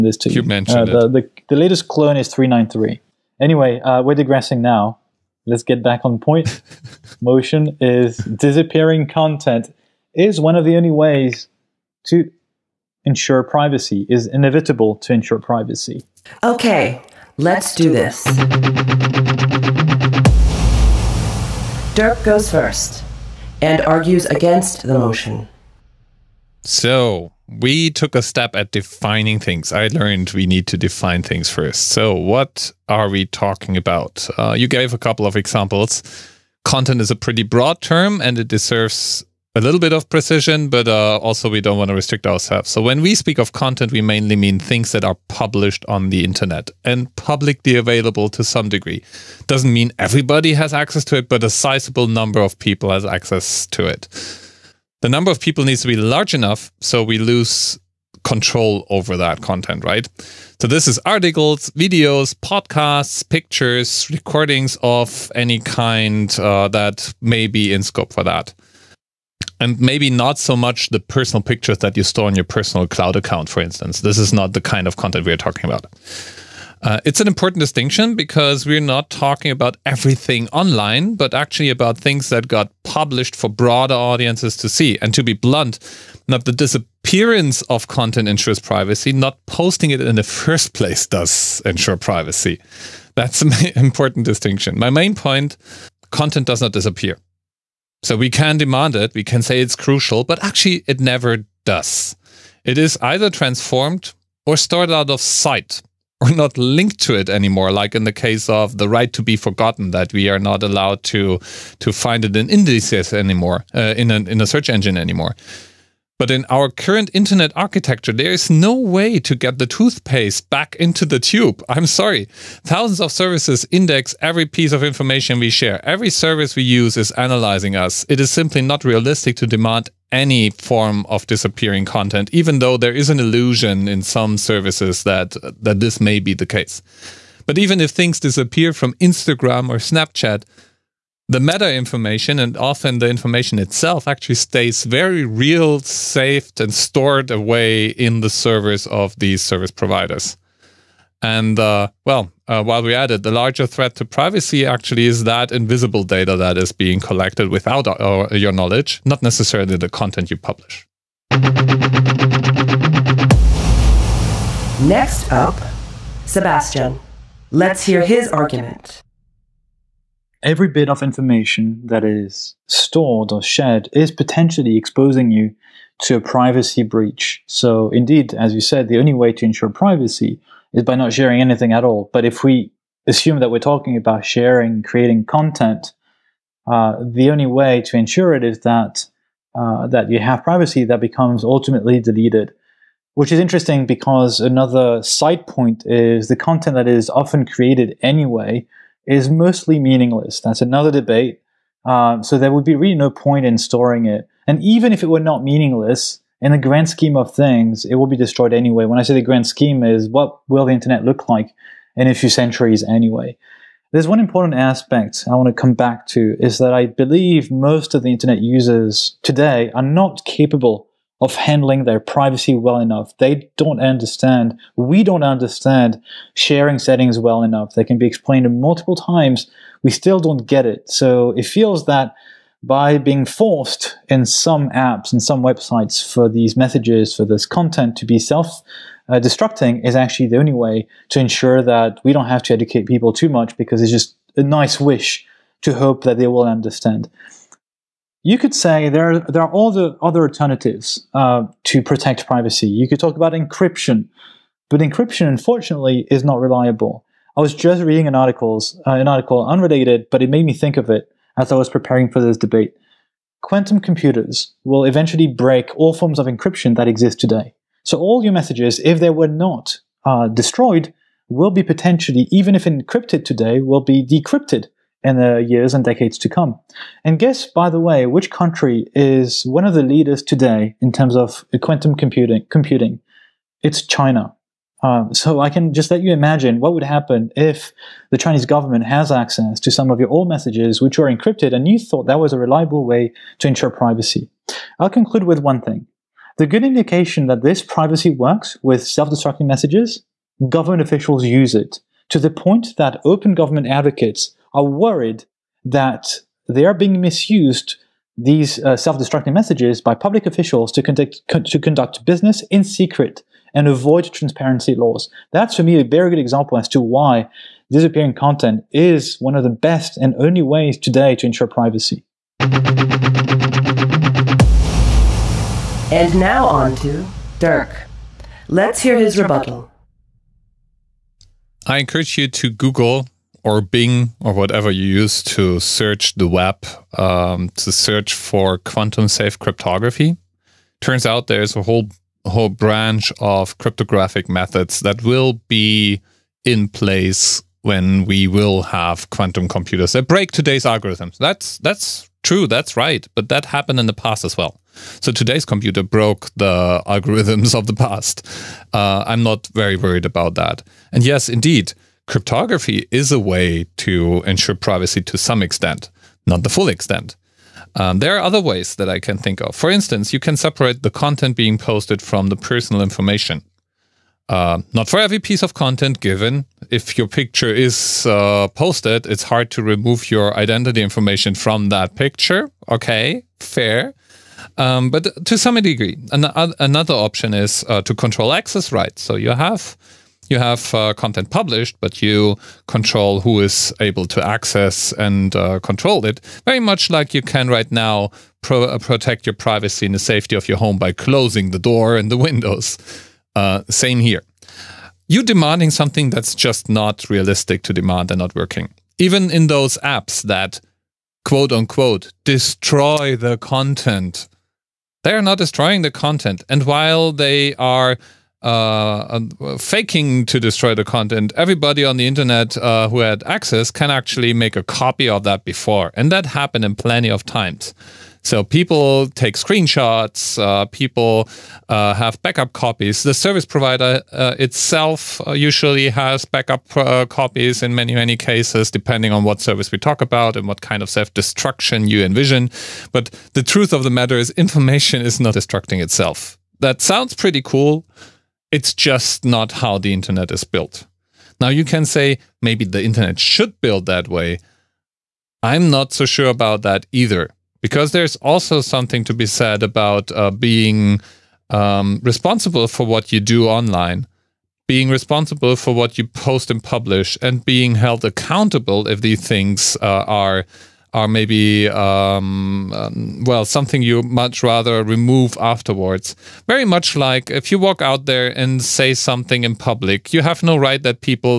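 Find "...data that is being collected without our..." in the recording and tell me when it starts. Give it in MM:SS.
02:36.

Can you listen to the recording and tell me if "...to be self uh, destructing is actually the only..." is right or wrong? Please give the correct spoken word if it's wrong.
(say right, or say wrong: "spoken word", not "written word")
right.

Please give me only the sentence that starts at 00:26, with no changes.
So, we took a step at defining things.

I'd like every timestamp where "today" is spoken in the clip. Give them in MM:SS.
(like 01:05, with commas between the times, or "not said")
03:39, 04:27, 04:33, 04:40, 05:20, 05:50, 05:55.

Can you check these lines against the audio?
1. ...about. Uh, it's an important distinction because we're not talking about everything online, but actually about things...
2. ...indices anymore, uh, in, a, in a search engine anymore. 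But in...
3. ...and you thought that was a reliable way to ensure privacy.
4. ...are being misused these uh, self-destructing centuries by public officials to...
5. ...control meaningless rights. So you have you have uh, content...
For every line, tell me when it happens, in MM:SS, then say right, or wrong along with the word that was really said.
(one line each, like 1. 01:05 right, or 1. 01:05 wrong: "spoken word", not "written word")
1. 01:15 right
2. 01:52 right
3. 04:51 right
4. 05:06 wrong: "messages", not "centuries"
5. 06:27 wrong: "access", not "meaningless".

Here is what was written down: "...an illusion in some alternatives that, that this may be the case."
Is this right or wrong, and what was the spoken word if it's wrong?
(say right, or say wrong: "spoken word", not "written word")
wrong: "services", not "alternatives".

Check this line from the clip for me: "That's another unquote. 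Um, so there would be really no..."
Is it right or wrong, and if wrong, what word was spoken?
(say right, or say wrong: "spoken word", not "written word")
wrong: "debate", not "unquote".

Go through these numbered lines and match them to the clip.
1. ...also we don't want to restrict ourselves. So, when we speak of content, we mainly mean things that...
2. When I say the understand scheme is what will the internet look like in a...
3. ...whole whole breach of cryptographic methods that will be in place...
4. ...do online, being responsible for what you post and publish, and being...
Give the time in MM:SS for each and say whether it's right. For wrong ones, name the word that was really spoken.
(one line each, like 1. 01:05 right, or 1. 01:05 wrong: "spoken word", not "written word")
1. 00:41 right
2. 03:28 wrong: "grand", not "understand"
3. 05:41 wrong: "branch", not "breach"
4. 07:43 right.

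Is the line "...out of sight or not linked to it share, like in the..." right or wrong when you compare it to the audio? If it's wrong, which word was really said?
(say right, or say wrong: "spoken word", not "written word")
wrong: "anymore", not "share".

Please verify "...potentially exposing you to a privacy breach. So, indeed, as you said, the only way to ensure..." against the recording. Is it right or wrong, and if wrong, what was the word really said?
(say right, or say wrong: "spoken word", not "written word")
right.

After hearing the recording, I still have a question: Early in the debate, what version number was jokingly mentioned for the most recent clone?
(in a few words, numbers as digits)
393.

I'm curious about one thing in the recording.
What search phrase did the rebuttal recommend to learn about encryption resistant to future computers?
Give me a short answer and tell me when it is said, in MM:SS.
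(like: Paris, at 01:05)
quantum safe cryptography, at 05:38.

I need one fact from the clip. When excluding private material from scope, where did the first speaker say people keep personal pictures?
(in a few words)
personal cloud account.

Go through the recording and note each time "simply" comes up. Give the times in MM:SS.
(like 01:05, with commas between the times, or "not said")
02:08.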